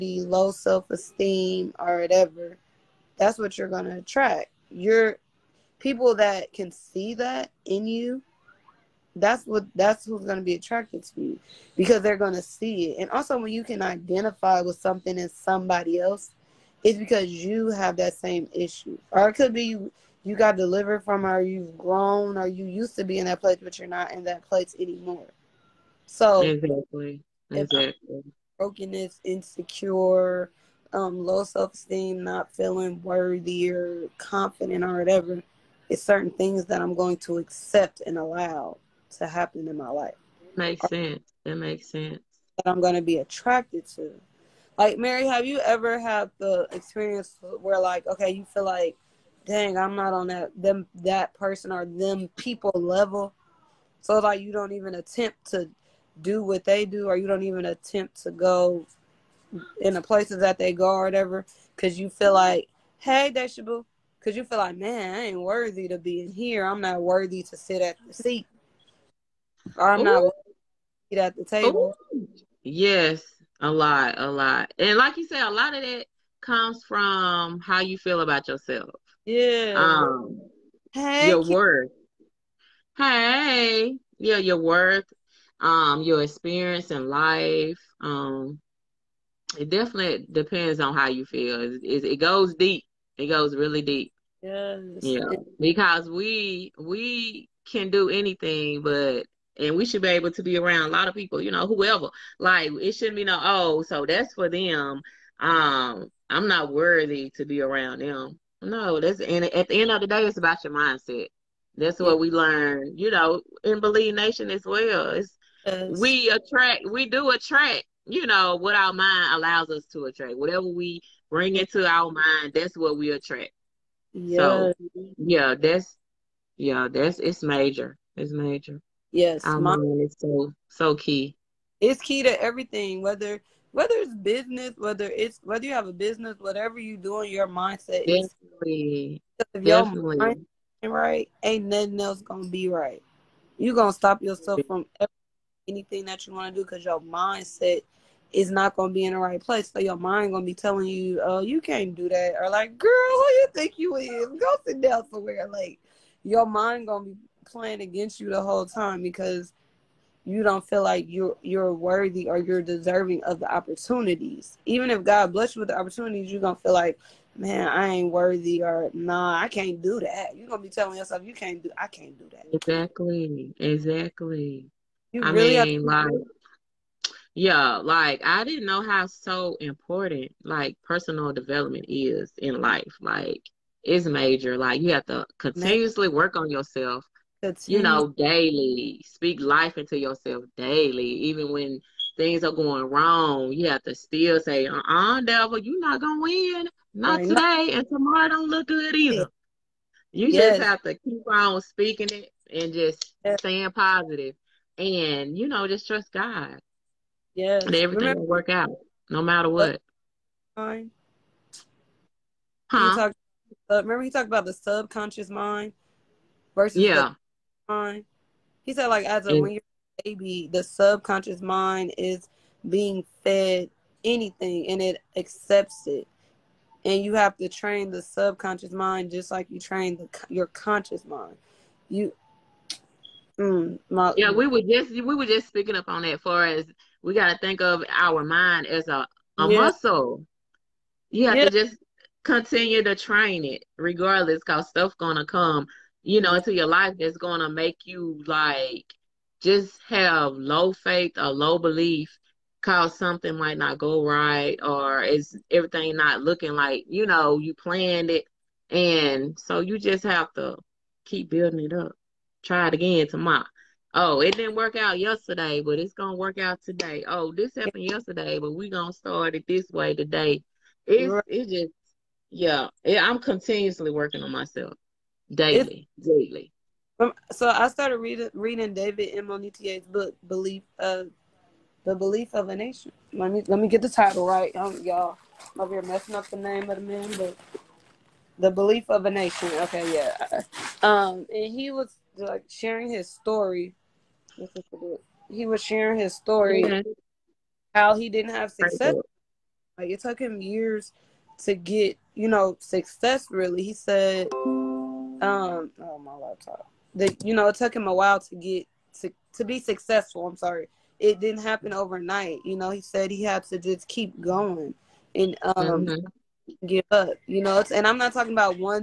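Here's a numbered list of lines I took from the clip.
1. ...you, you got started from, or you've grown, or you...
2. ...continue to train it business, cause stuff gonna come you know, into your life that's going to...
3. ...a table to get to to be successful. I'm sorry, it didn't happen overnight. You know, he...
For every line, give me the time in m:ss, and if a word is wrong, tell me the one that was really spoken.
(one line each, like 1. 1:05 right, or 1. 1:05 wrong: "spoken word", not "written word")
1. 0:19 wrong: "delivered", not "started"
2. 4:02 wrong: "regardless", not "business"
3. 5:07 wrong: "while", not "table".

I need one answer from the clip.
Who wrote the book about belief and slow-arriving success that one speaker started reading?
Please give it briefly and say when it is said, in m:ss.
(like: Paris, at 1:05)
David M. Monitier, at 4:38.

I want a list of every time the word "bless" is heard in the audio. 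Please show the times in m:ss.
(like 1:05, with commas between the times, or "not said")
2:45.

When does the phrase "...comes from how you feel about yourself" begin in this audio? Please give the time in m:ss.
1:16.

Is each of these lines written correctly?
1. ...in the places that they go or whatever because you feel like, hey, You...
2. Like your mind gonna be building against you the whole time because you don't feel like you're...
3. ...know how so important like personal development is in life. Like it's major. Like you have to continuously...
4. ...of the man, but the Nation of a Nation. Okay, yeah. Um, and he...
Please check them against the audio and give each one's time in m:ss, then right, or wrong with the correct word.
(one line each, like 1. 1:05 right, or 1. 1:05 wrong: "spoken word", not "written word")
1. 0:59 wrong: "Deshabu", not "You"
2. 2:35 wrong: "playing", not "building"
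3. 2:58 right
4. 4:46 wrong: "Belief", not "Nation".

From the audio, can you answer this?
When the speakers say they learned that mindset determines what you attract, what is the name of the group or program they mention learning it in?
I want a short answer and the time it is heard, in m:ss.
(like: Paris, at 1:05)
Believe Nation, at 1:53.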